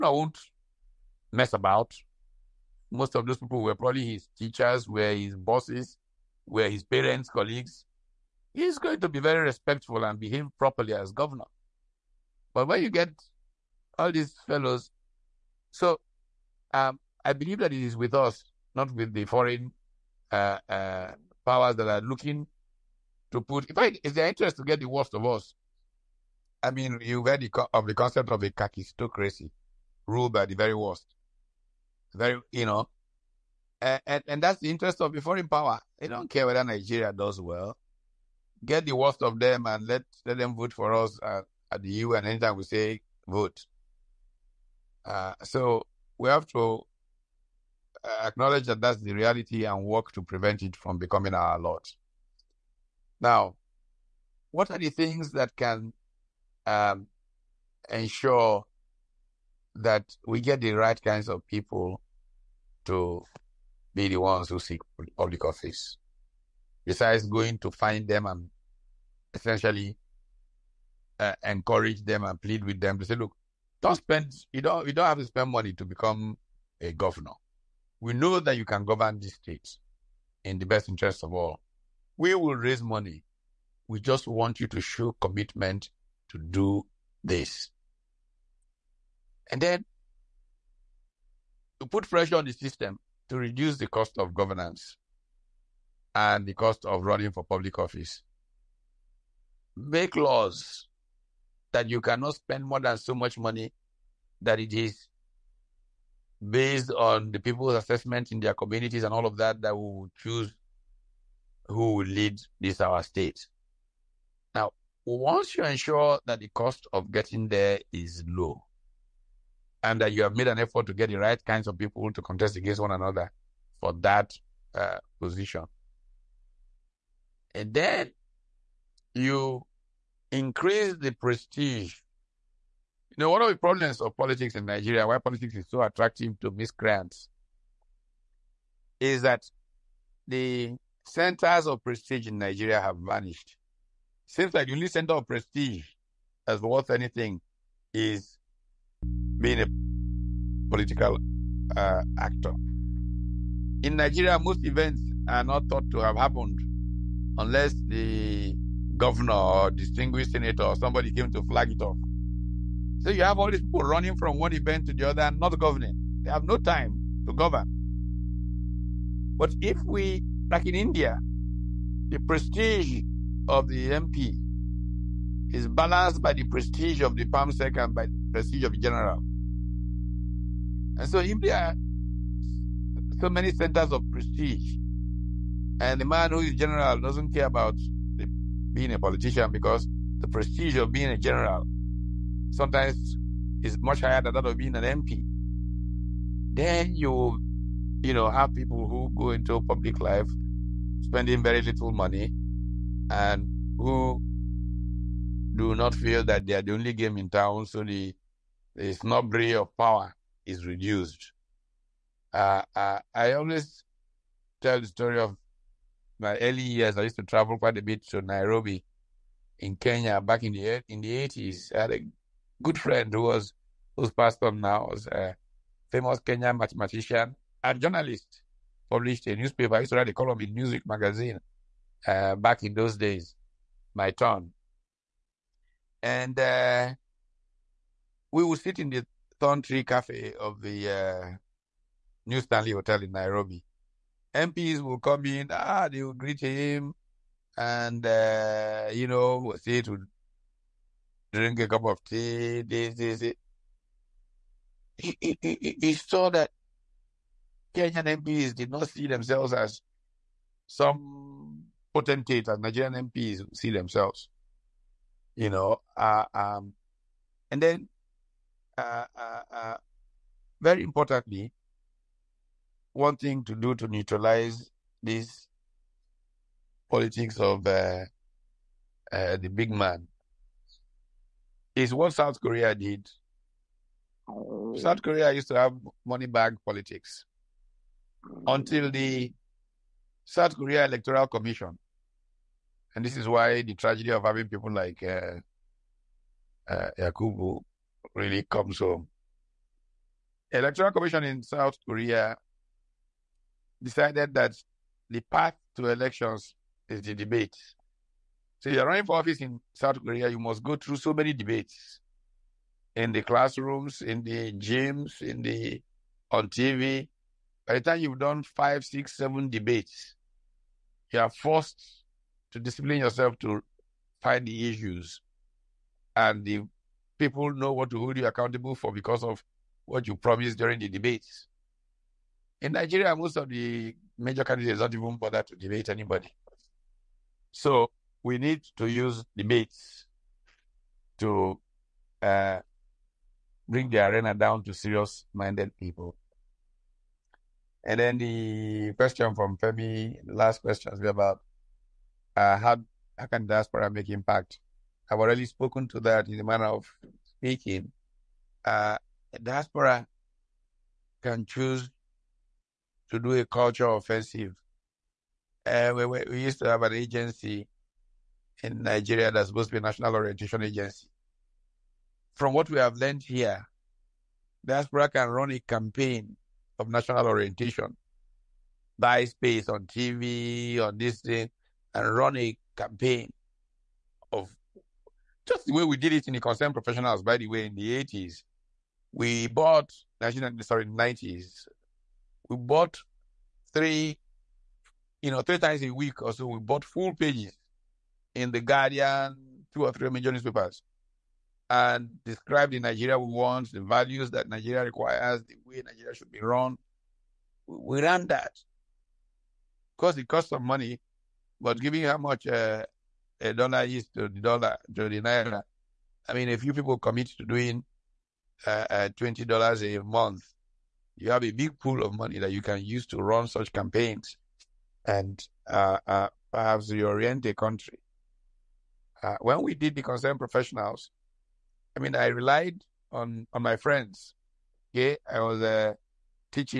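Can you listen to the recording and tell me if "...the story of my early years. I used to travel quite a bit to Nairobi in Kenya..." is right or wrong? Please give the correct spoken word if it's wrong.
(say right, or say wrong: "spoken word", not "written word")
right.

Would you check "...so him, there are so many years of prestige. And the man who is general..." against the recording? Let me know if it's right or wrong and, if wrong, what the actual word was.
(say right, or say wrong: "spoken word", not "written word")
wrong: "centers", not "years".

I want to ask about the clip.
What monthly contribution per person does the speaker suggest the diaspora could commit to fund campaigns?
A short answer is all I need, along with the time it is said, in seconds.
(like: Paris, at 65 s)
$20, at 419 s.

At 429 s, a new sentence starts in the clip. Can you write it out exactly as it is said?
when we did the concerned professionals, I mean, I relied on on my friends.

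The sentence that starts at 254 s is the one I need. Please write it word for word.
he, he, he saw that Kenyan MPs did not see themselves as some potentators, Nigerian MPs see themselves, you know.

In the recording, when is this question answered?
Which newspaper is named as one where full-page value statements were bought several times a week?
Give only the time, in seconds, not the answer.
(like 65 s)
398 s.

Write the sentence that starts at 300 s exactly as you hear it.
Electoral Commission in South Korea decided that the path to elections is the debate.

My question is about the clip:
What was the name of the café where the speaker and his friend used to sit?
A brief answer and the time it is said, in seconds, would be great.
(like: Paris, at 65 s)
Thorn Tree Cafe, at 239 s.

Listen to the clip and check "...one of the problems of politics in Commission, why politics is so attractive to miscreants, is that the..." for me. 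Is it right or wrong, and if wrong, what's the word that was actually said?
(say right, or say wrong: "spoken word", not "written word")
wrong: "Nigeria", not "Commission".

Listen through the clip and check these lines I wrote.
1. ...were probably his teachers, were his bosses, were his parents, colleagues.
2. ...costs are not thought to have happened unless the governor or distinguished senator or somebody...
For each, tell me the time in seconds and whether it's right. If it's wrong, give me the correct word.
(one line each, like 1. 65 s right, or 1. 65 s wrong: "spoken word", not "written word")
1. 3 s right
2. 154 s wrong: "events", not "costs".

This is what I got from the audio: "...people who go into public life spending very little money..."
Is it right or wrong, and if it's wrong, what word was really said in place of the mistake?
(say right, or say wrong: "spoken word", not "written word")
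right.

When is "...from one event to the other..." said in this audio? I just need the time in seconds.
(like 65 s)
164 s.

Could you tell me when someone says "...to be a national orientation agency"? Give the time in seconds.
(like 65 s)
369 s.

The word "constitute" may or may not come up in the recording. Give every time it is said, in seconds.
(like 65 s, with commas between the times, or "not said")
not said.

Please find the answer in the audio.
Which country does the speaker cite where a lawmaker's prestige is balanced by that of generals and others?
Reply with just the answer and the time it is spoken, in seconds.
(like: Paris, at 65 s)
India, at 170 s.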